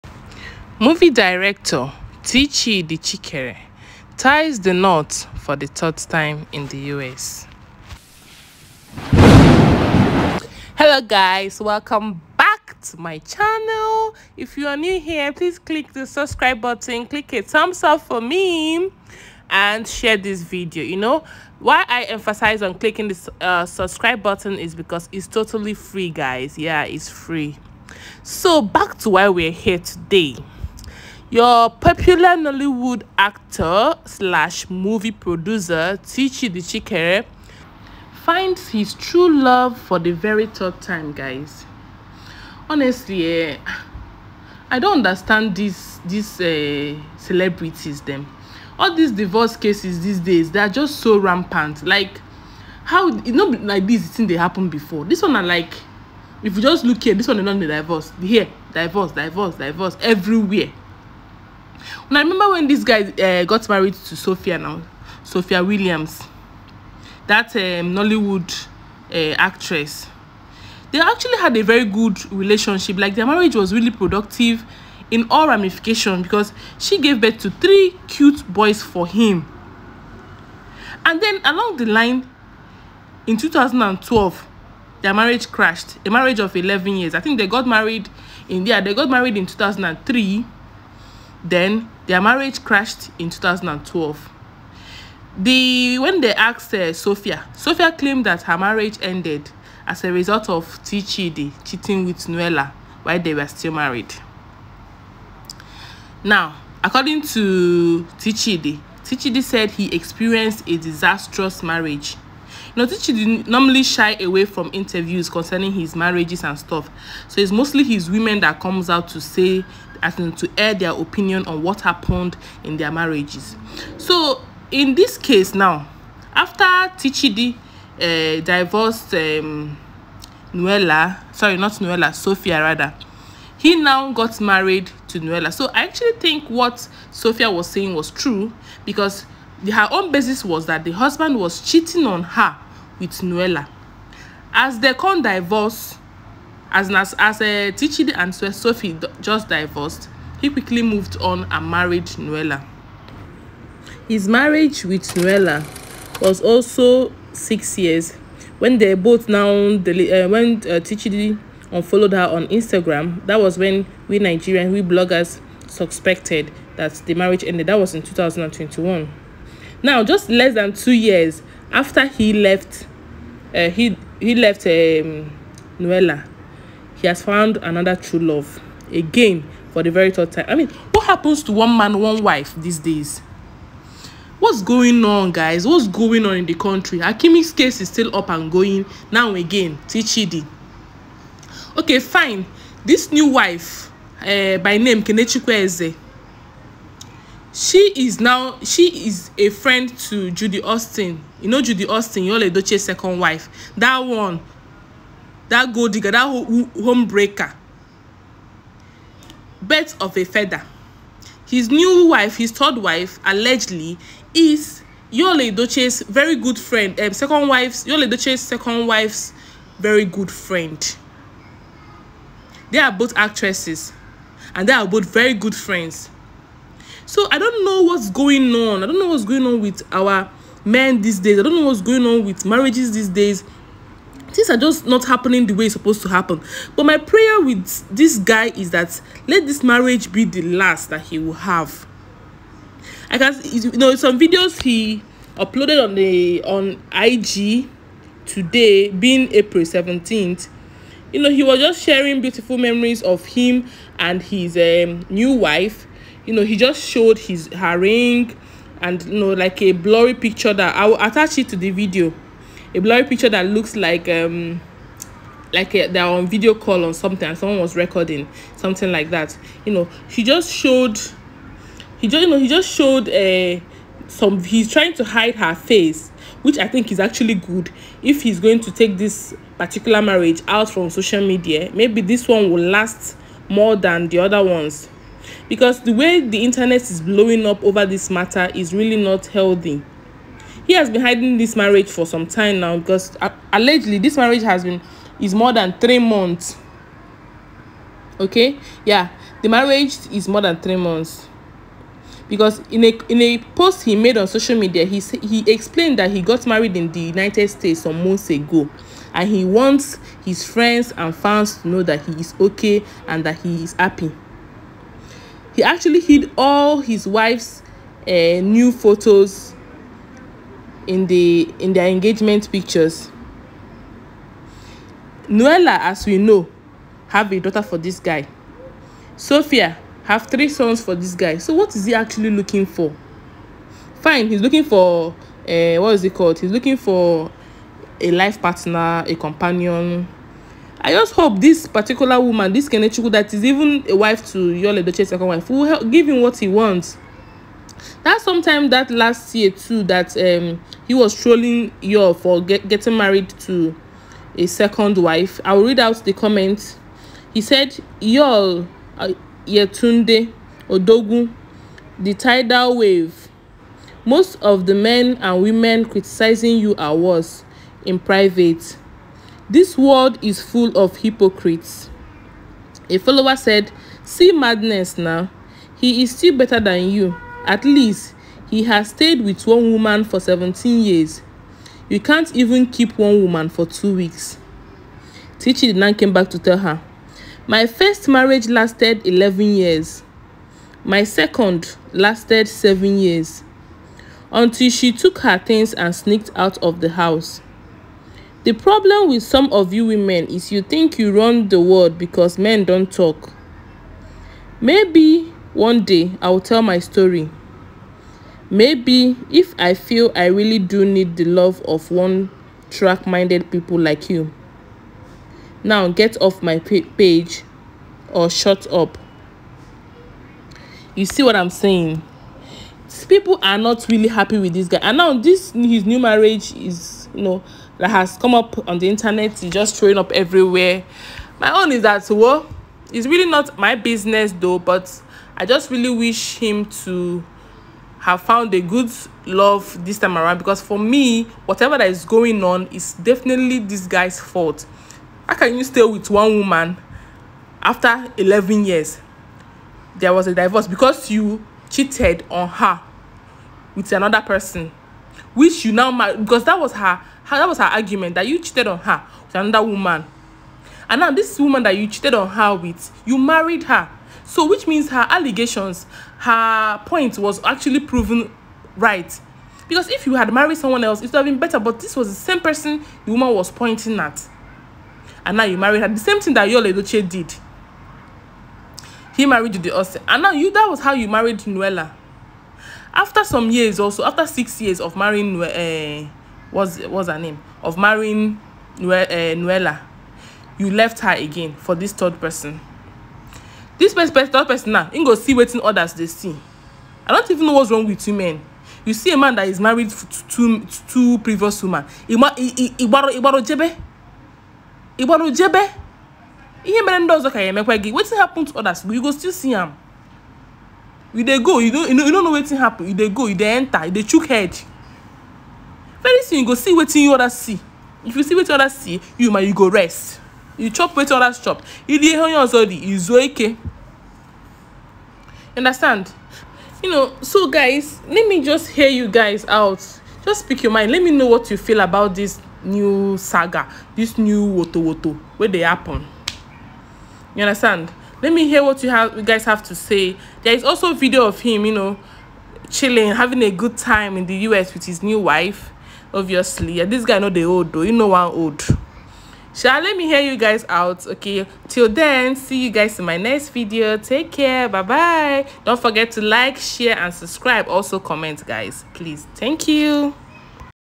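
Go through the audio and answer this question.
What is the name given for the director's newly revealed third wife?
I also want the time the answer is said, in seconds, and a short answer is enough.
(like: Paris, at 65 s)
Kenechikwe Eze, at 195 s.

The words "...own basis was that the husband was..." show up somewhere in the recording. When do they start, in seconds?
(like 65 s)
139 s.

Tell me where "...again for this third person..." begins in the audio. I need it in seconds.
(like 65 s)
491 s.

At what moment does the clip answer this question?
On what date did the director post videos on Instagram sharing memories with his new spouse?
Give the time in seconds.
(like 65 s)
249 s.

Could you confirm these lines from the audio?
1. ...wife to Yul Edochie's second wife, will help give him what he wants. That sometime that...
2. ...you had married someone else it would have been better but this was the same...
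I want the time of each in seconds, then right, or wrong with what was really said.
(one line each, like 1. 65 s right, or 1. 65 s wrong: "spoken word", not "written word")
1. 343 s right
2. 470 s right.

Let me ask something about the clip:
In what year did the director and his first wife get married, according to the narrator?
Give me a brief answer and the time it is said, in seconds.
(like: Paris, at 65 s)
2003, at 89 s.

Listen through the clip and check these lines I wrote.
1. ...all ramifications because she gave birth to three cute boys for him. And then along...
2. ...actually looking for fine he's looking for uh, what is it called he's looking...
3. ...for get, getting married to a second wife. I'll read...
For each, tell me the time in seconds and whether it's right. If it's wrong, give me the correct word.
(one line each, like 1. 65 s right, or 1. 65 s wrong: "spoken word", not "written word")
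1. 75 s right
2. 331 s right
3. 352 s right.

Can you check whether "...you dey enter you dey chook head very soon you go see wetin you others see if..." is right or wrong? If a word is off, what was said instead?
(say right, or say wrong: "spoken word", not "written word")
right.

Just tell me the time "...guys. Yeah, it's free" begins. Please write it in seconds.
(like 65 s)
26 s.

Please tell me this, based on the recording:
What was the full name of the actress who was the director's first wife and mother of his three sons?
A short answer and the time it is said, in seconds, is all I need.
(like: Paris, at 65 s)
Sophia Williams, at 65 s.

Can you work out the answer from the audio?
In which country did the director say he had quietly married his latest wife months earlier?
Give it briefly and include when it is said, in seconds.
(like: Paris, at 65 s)
United States, at 307 s.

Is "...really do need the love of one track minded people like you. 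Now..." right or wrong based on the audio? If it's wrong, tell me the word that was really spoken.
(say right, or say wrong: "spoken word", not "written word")
right.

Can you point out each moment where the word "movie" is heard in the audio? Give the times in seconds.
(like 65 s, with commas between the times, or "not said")
0 s, 34 s.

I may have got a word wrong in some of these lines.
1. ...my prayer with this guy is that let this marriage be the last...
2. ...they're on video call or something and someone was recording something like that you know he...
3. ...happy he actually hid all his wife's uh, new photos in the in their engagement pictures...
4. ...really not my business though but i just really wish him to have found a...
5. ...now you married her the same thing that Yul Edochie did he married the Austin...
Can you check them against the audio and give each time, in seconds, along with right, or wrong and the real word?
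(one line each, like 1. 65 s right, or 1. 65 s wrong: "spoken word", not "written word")
1. 236 s right
2. 265 s right
3. 313 s right
4. 433 s right
5. 475 s right.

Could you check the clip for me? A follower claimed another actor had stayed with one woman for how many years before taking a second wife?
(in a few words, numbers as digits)
17.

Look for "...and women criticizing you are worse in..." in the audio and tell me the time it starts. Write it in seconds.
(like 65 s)
365 s.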